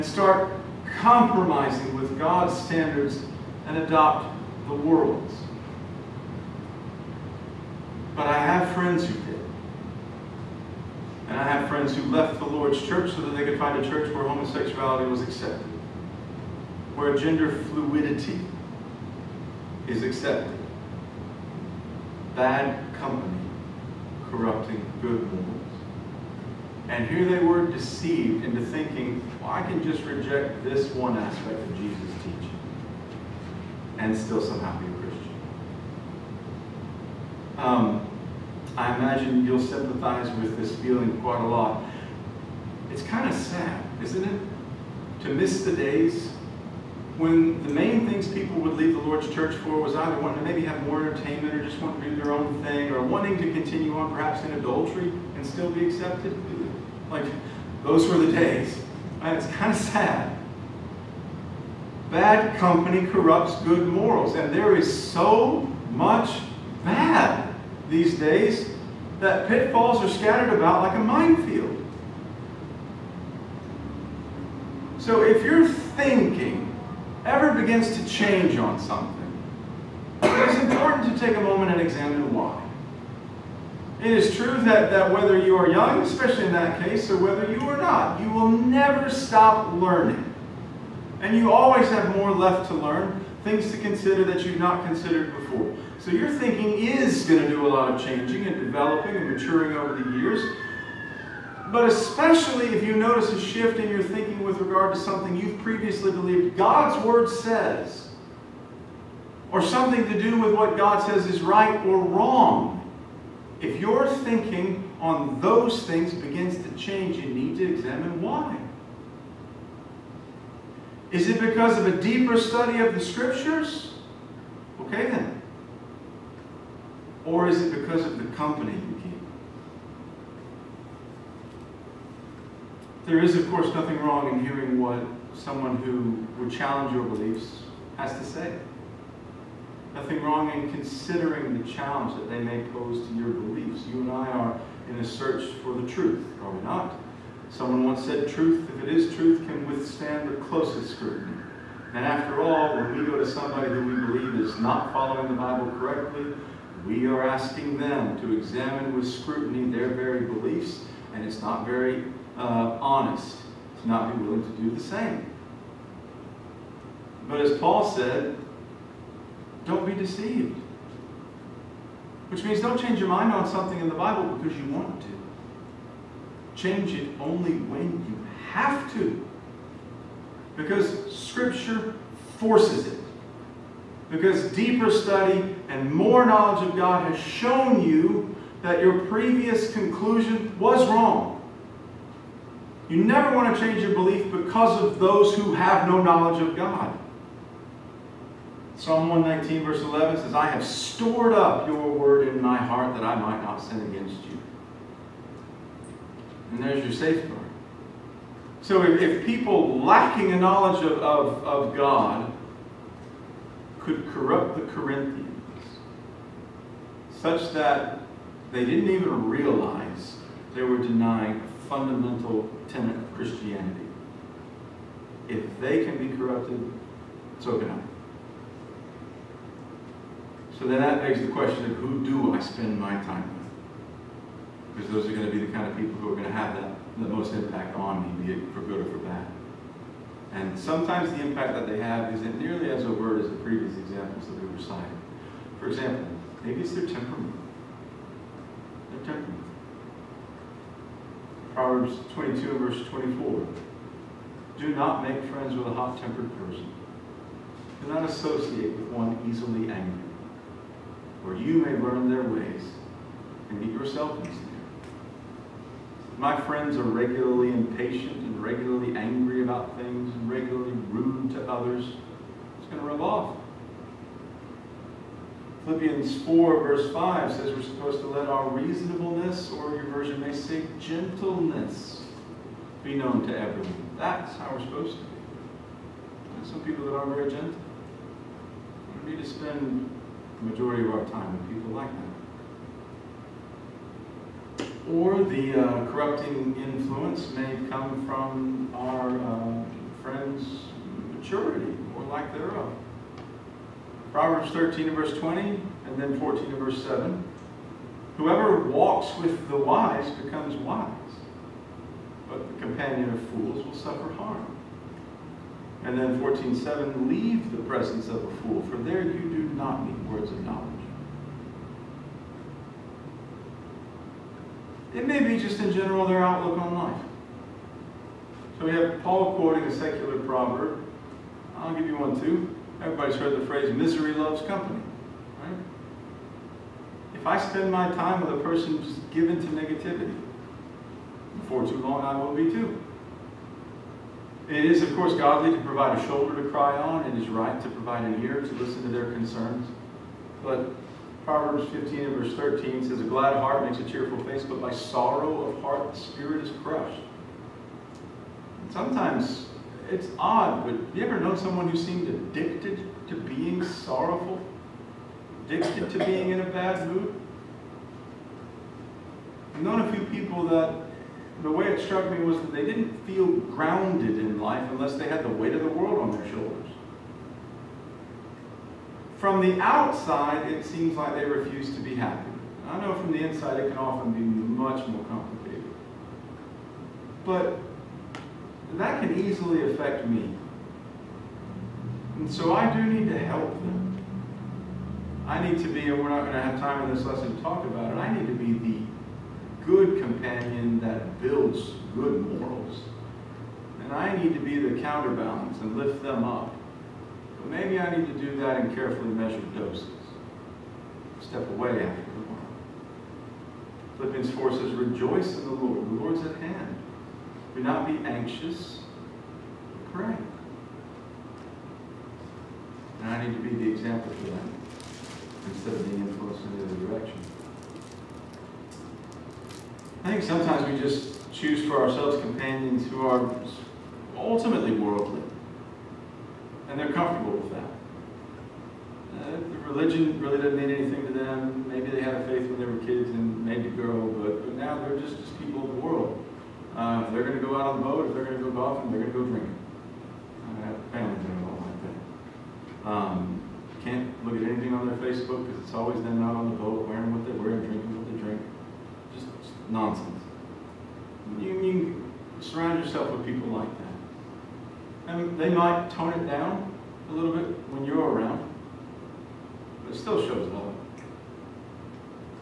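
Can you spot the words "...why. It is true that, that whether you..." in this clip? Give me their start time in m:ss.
1:22.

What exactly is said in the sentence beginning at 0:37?
Um, I imagine you'll sympathize with this feeling quite a lot.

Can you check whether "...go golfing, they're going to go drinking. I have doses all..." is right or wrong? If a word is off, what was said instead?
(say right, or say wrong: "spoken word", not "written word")
wrong: "families", not "doses".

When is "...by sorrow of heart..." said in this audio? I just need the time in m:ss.
5:54.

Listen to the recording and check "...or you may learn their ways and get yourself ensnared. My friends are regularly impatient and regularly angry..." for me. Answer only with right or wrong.
right.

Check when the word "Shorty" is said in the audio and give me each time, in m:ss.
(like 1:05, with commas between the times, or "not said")
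not said.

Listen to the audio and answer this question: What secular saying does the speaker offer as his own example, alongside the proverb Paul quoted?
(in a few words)
Misery loves company.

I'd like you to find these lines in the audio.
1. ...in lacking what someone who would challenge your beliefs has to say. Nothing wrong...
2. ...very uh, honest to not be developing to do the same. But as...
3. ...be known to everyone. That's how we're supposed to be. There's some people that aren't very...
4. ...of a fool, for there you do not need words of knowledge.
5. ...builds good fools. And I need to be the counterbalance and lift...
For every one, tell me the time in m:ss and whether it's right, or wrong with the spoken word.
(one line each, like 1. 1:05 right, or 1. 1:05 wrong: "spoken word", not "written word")
1. 2:14 wrong: "hearing", not "lacking"
2. 2:41 wrong: "willing", not "developing"
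3. 4:42 right
4. 5:18 right
5. 6:41 wrong: "morals", not "fools".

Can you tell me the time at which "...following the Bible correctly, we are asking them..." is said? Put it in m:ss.
2:34.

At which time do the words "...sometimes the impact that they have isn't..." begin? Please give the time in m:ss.
4:00.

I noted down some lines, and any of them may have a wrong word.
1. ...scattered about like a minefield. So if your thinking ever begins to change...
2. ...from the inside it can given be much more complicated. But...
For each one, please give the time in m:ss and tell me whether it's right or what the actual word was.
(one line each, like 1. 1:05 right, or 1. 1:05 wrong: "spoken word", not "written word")
1. 1:10 right
2. 6:22 wrong: "often", not "given".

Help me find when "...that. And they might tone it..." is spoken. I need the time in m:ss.
7:43.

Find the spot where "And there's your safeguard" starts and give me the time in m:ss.
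3:26.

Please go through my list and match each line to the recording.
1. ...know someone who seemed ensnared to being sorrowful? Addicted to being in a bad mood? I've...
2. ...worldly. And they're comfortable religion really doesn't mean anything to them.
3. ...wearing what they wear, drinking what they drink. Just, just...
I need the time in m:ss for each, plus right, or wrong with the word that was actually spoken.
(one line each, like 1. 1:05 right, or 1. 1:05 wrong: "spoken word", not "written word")
1. 6:01 wrong: "addicted", not "ensnared"
2. 7:14 right
3. 7:36 right.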